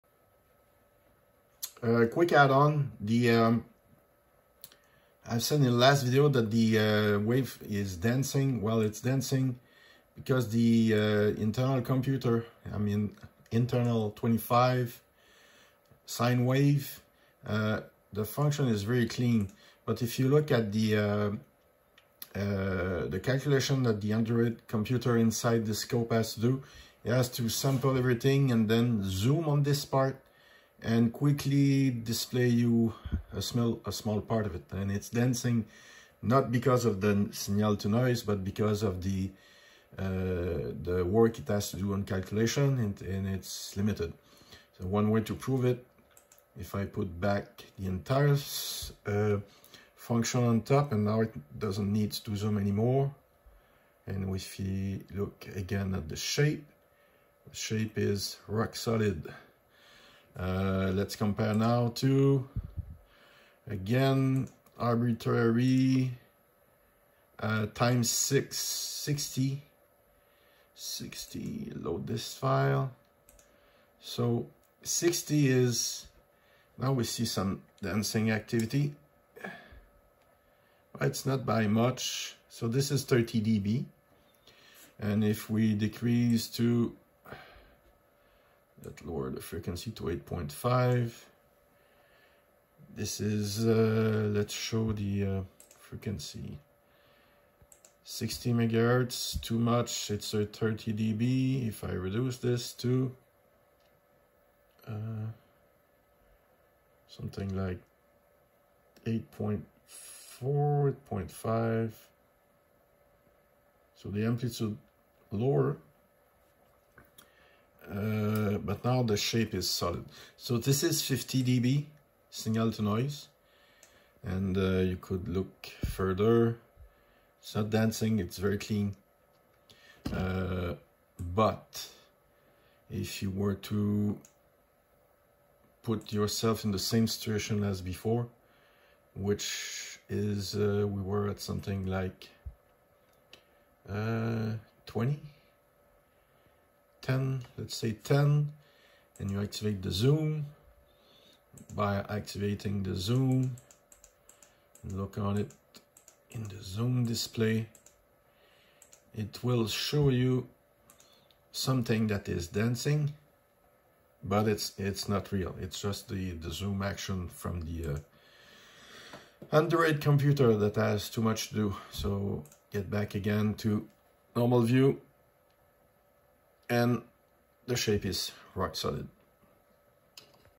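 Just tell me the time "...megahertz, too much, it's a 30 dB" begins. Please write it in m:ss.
1:38.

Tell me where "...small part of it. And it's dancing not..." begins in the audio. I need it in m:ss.
0:33.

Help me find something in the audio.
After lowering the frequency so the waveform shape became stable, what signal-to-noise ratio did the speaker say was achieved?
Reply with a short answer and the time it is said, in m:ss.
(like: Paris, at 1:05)
50 dB, at 2:01.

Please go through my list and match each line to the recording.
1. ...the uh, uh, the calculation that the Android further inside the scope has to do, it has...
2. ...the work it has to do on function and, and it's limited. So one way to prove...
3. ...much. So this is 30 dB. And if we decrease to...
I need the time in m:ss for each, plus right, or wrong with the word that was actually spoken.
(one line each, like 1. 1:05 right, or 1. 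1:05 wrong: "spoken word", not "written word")
1. 0:20 wrong: "computer", not "further"
2. 0:40 wrong: "calculation", not "function"
3. 1:21 right.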